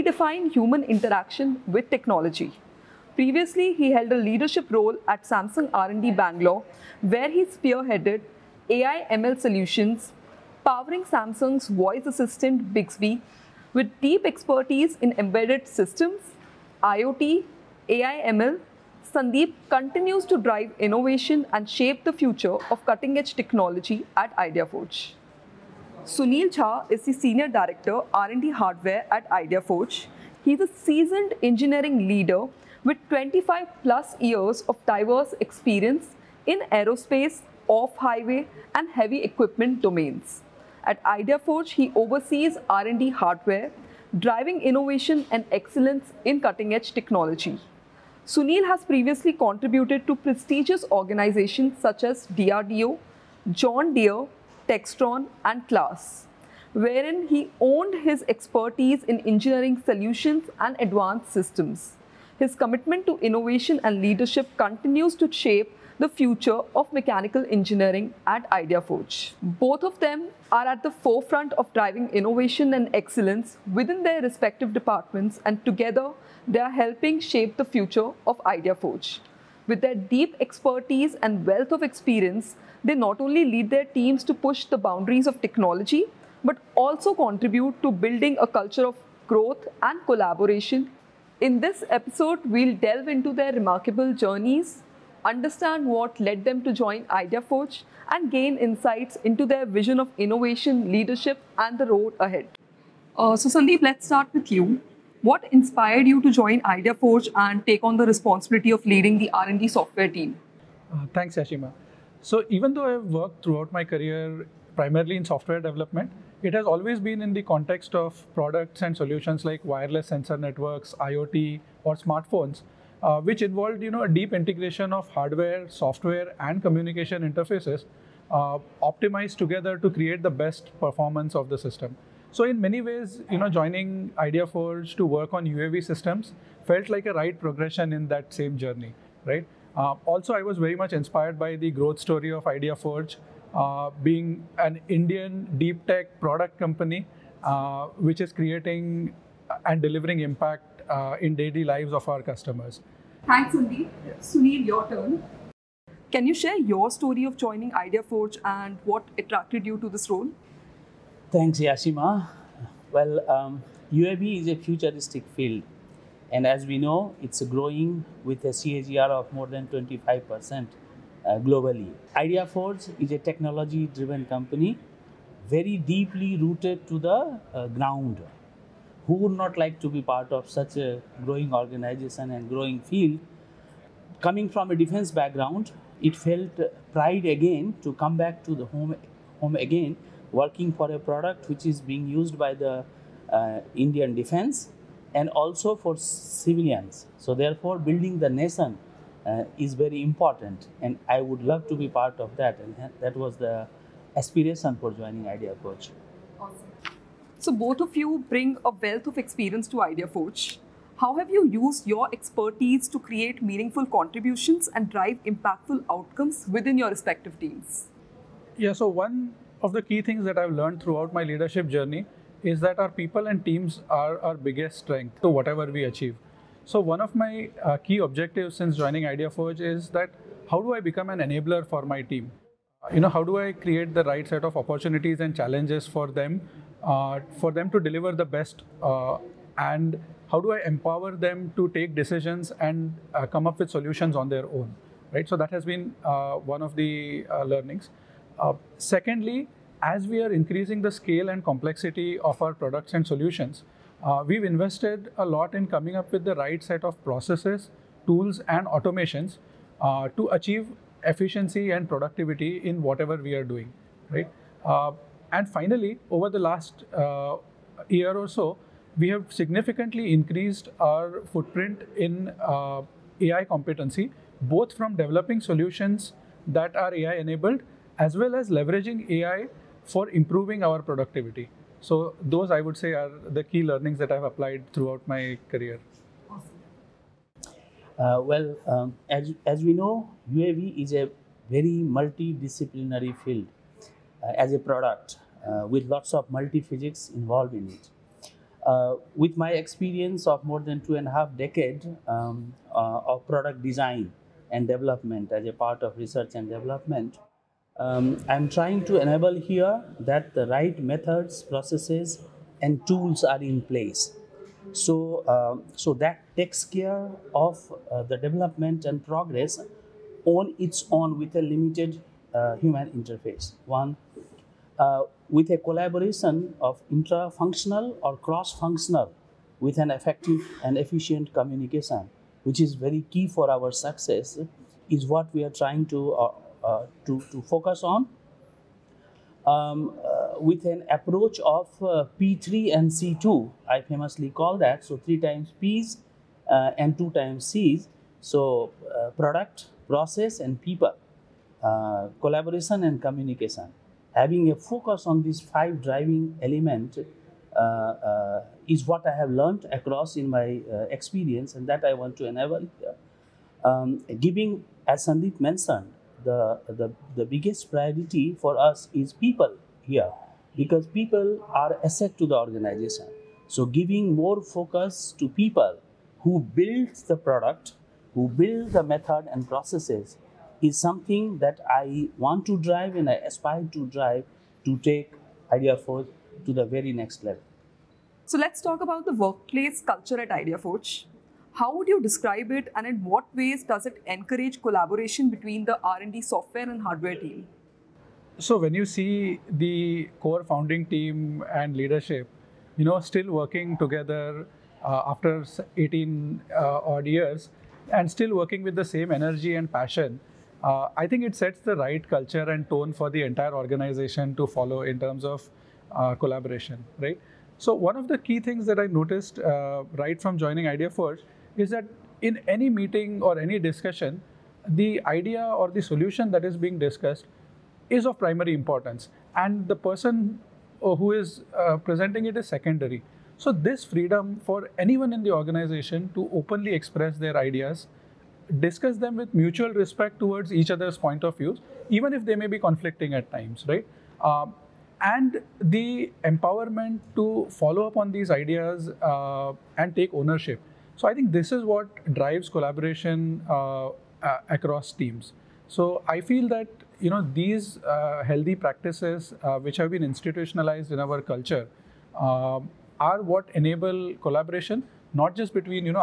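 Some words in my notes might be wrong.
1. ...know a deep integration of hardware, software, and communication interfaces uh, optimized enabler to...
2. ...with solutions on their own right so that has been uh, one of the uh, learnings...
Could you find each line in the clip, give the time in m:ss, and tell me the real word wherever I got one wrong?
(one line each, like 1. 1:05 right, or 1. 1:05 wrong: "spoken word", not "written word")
1. 2:03 wrong: "together", not "enabler"
2. 4:03 right.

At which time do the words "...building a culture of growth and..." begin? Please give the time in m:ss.
1:27.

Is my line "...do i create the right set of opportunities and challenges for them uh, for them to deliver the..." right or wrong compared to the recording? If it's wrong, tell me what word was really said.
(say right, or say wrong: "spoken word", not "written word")
right.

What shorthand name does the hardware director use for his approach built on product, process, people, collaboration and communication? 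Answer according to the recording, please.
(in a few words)
P3 and C2.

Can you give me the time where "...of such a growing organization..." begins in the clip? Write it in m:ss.
3:00.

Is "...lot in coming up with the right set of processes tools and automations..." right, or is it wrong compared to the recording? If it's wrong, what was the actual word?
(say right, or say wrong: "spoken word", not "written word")
right.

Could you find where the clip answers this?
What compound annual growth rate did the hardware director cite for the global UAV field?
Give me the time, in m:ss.
2:49.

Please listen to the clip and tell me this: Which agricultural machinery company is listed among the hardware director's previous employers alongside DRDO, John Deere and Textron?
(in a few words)
CLAAS.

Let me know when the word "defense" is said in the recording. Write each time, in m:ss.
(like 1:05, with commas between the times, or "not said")
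3:04, 3:14.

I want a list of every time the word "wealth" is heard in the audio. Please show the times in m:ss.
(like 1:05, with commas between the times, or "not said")
1:21, 3:28.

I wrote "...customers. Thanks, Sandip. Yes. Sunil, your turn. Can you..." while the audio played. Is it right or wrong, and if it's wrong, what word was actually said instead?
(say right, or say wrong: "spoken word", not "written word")
right.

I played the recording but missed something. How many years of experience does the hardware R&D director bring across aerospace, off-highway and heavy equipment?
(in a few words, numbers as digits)
25 plus.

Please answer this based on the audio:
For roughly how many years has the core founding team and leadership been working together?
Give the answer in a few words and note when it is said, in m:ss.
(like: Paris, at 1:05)
18, at 6:45.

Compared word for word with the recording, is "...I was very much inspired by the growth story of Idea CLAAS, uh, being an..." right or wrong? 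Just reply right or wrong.
wrong.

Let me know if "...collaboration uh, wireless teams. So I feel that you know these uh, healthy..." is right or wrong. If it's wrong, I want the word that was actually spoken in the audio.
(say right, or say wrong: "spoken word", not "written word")
wrong: "across", not "wireless".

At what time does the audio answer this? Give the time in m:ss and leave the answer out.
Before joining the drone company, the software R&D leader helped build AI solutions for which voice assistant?
0:12.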